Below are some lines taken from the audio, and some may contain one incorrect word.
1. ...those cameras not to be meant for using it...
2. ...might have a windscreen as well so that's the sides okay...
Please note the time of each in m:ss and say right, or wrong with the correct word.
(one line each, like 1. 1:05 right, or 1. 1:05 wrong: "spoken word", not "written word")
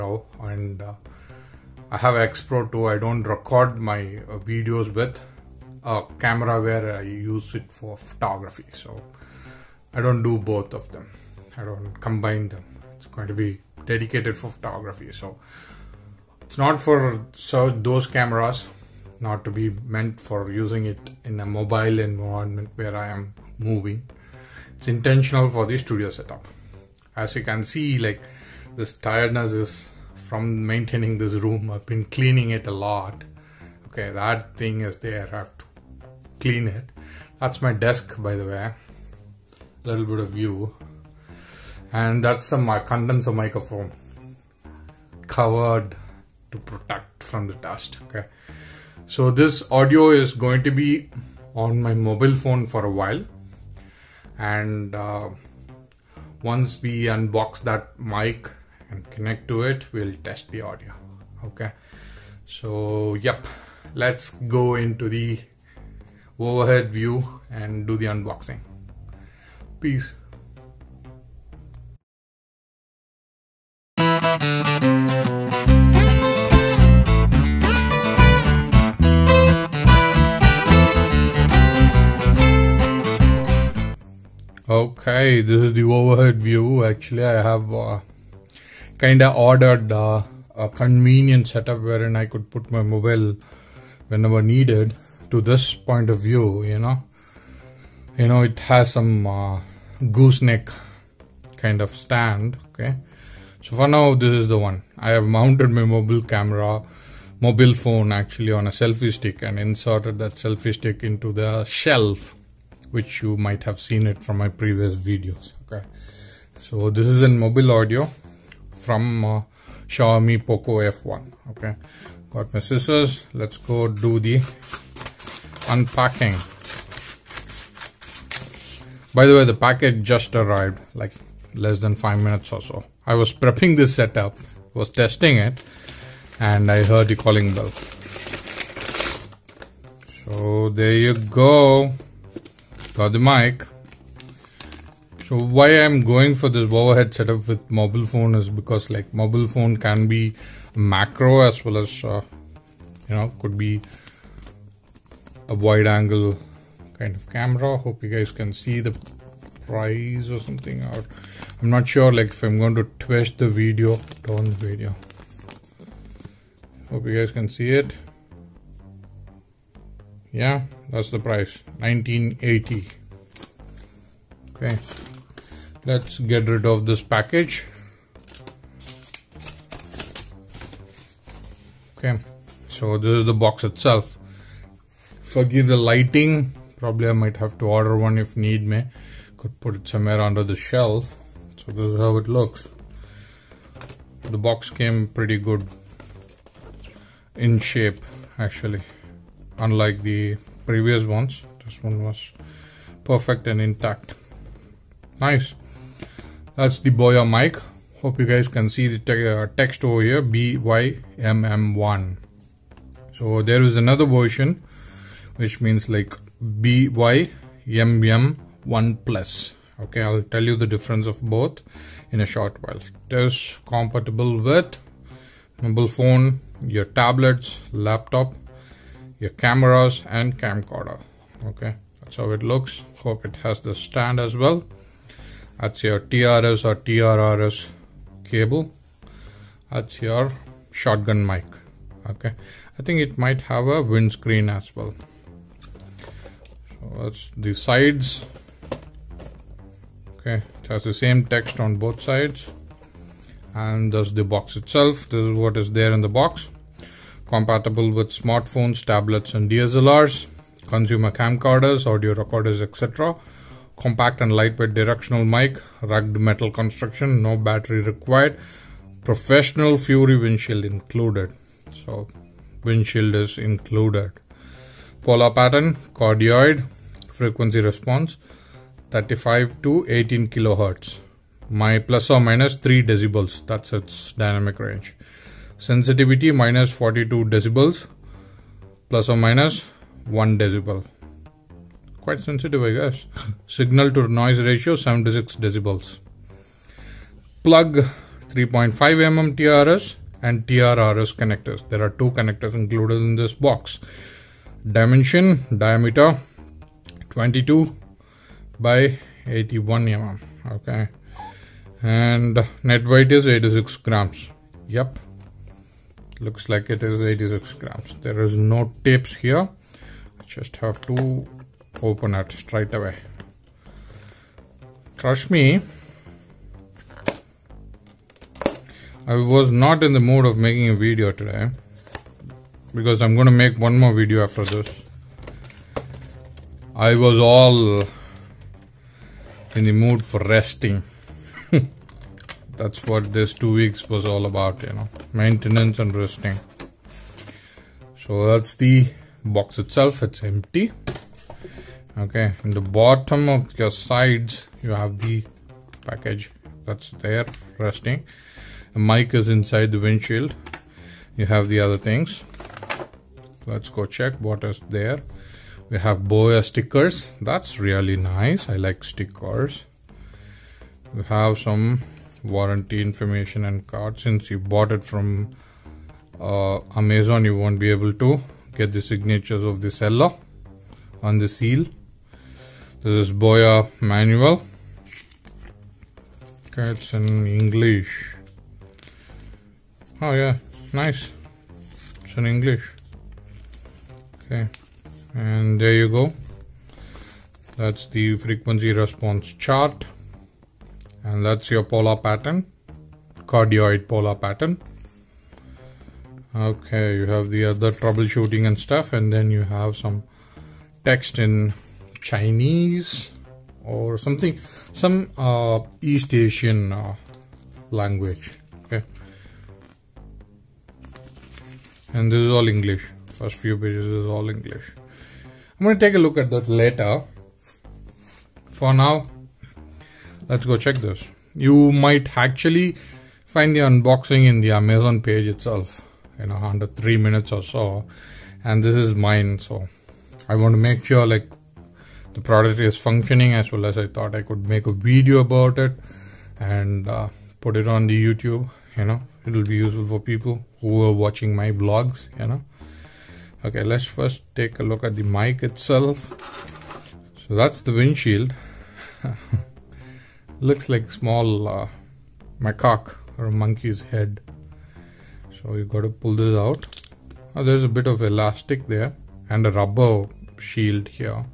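1. 0:17 right
2. 4:03 right.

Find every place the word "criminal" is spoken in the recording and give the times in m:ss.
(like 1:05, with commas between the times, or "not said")
not said.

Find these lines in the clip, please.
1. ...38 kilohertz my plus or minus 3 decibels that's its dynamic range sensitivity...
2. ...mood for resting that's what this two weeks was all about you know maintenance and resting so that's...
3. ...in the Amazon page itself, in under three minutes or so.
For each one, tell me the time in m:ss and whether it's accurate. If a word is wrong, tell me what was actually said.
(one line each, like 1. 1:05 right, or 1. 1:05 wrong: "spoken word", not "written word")
1. 4:39 wrong: "18", not "38"
2. 5:39 right
3. 7:14 right.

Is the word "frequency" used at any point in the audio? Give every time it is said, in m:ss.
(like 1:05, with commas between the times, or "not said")
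4:37, 6:38.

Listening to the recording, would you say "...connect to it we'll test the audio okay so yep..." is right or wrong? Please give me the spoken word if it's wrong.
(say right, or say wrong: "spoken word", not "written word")
right.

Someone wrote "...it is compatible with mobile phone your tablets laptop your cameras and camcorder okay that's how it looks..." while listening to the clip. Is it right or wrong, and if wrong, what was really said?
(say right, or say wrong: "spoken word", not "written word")
right.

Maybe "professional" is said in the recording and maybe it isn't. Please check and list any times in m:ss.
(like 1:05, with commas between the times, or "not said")
4:29.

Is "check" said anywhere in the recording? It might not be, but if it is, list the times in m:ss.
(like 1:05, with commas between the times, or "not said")
6:03, 7:10.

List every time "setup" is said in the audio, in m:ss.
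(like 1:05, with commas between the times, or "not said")
0:26, 1:31, 2:13, 2:27.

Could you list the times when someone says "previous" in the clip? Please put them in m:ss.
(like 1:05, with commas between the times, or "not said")
1:54, 3:20.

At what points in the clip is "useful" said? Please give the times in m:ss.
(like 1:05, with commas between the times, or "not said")
7:29.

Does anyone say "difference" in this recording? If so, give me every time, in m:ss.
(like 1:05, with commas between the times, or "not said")
3:40.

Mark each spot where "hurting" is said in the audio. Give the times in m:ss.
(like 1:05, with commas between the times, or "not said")
not said.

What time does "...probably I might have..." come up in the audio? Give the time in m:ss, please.
3:06.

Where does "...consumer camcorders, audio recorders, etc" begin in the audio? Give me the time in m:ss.
4:20.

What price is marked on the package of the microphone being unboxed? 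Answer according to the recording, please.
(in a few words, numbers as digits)
1980.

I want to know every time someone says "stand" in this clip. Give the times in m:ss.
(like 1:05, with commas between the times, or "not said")
1:41, 3:53.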